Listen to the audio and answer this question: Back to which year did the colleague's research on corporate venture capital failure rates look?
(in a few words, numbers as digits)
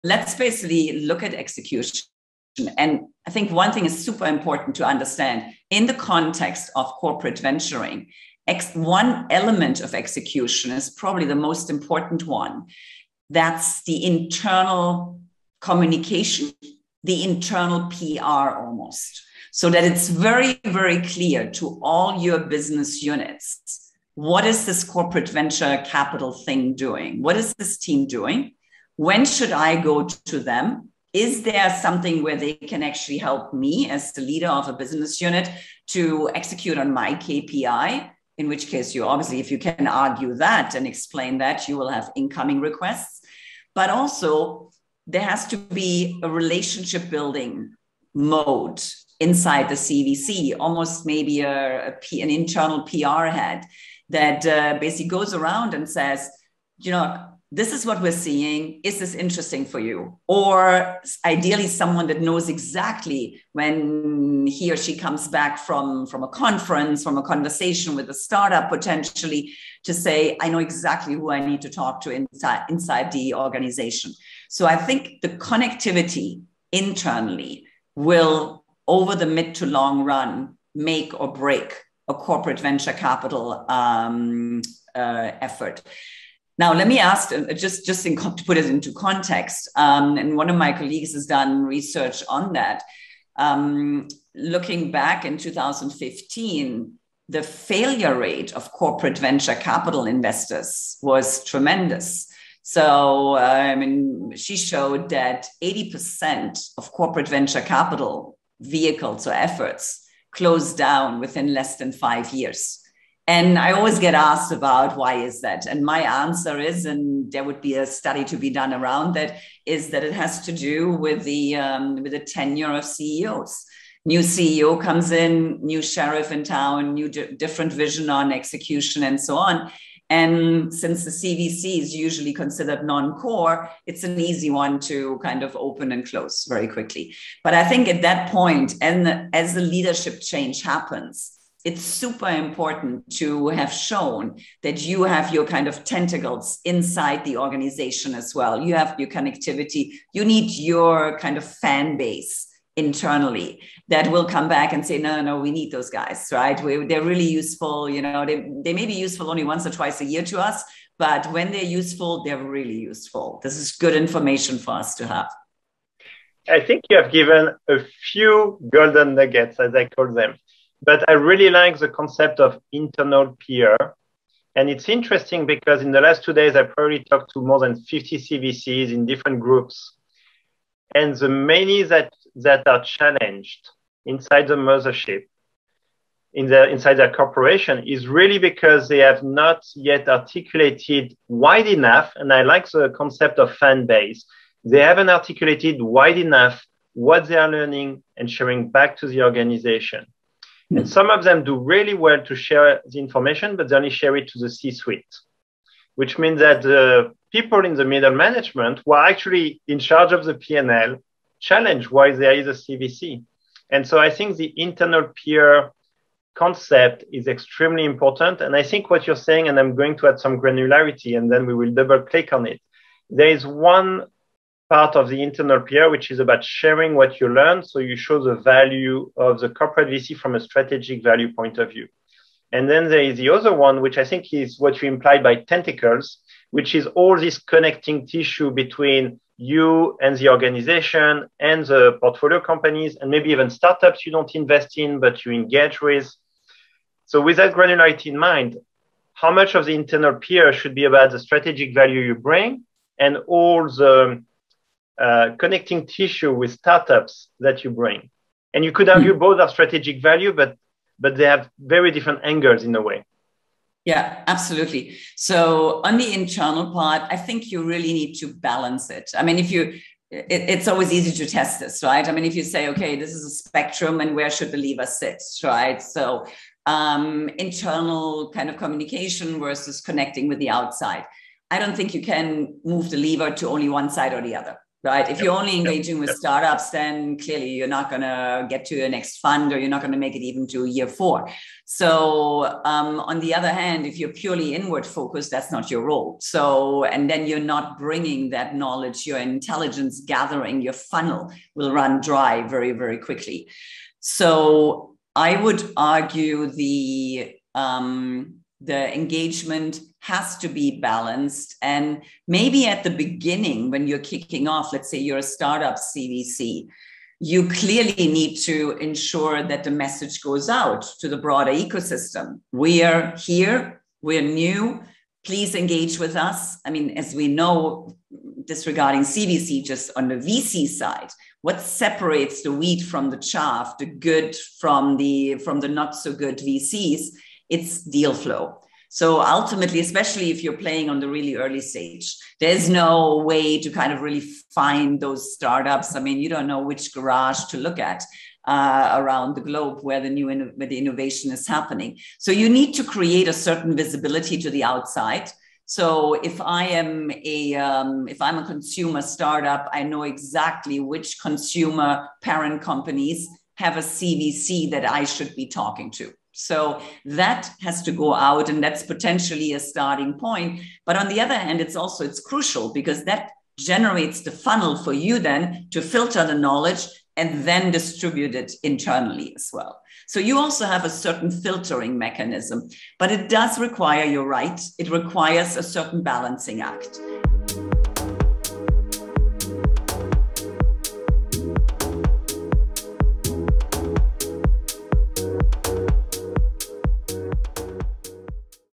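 2015.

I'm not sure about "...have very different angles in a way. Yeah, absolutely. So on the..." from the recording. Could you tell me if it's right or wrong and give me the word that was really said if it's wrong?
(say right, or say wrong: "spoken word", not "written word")
right.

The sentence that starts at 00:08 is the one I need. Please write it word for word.
Ex- one element of execution is probably the most important one.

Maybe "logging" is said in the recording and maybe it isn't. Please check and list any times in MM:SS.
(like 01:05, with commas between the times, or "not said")
not said.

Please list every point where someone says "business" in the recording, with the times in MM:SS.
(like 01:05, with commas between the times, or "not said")
00:22, 00:34.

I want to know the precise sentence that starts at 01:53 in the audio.
And I always get asked about why is that?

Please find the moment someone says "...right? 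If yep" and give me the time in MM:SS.
04:44.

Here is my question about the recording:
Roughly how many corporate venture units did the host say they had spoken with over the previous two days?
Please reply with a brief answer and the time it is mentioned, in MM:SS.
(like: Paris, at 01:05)
more than 50, at 02:57.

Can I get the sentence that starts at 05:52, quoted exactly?
So you need to create a certain visibility to the outside.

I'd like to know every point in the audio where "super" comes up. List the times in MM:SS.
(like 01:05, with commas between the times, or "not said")
00:04, 02:21.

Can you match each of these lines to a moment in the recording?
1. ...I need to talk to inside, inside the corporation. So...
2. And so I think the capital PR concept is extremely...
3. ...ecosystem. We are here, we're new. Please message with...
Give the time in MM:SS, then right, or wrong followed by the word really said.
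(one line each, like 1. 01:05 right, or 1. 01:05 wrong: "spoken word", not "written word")
1. 01:11 wrong: "organization", not "corporation"
2. 03:33 wrong: "internal", not "capital"
3. 05:21 wrong: "engage", not "message".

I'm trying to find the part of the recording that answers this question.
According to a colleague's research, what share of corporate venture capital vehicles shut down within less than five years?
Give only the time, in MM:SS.
01:45.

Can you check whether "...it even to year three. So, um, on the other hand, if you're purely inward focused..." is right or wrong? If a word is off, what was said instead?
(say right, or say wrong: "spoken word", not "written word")
wrong: "four", not "three".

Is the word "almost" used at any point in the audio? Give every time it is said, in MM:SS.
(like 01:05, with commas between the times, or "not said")
00:18, 00:50.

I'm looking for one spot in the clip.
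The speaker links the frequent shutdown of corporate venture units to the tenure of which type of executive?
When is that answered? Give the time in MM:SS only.
02:02.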